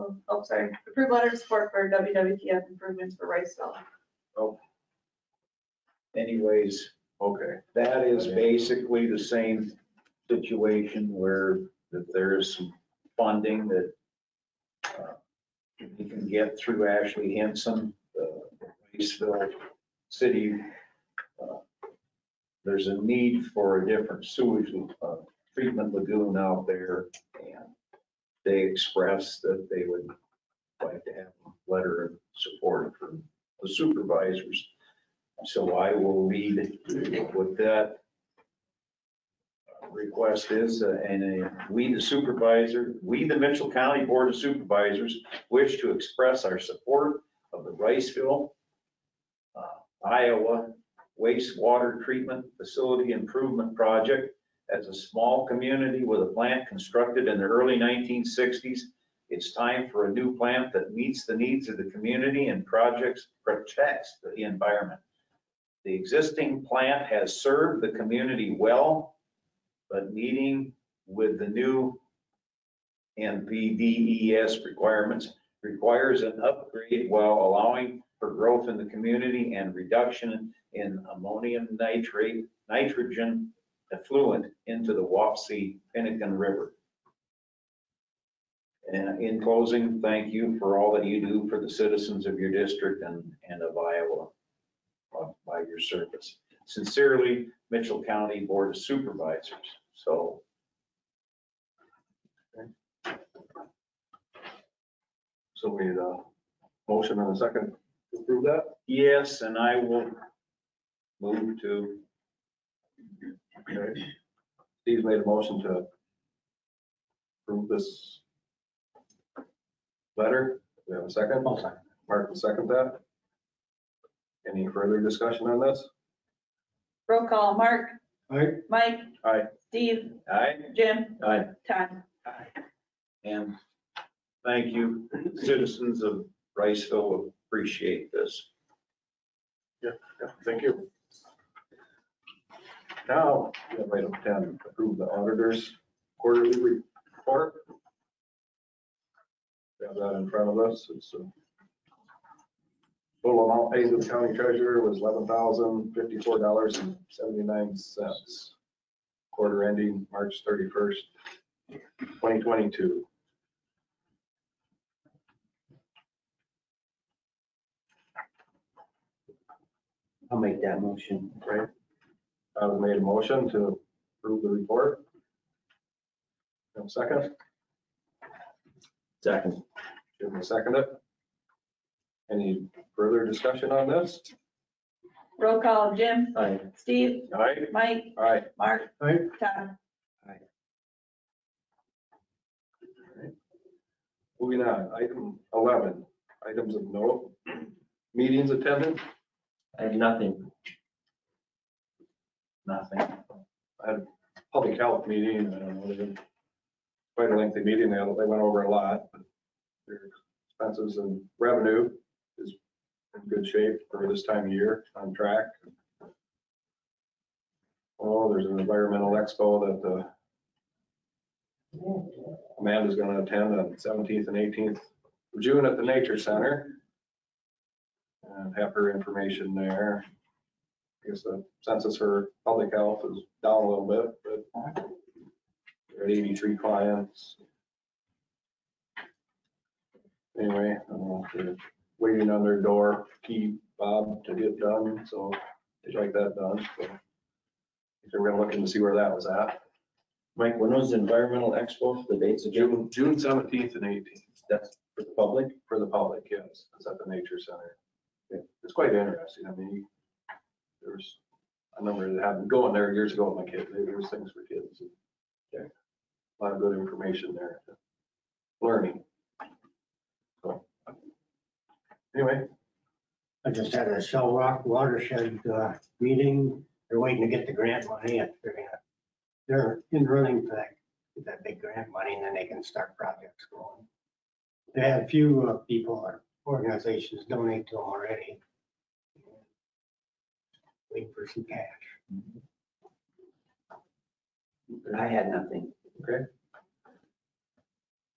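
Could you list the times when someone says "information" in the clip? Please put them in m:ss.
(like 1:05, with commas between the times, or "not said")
3:48, 4:26.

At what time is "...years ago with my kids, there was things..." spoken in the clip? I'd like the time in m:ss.
4:22.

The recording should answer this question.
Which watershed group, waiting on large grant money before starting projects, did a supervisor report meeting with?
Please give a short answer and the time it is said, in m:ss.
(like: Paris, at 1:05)
Shell Rock, at 4:34.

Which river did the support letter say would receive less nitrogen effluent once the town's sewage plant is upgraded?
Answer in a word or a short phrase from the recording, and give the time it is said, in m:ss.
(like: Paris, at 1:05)
Wapsie Pinnakin River, at 1:25.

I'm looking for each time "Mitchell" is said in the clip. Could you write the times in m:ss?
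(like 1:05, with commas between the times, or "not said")
0:43, 1:37.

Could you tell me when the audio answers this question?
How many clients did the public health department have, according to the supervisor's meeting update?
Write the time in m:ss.
3:56.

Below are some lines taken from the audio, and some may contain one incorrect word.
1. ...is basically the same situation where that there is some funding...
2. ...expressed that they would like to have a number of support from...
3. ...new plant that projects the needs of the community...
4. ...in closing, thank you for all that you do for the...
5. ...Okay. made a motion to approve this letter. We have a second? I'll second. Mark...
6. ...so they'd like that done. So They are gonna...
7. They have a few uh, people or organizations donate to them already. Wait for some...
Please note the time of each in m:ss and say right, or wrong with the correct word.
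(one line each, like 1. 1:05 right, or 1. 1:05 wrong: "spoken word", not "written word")
1. 0:08 right
2. 0:28 wrong: "letter", not "number"
3. 1:00 wrong: "meets", not "projects"
4. 1:29 right
5. 1:53 right
6. 4:05 right
7. 4:44 right.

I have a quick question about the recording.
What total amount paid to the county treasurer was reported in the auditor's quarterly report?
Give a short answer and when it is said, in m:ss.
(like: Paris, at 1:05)
$11,054.79, at 2:34.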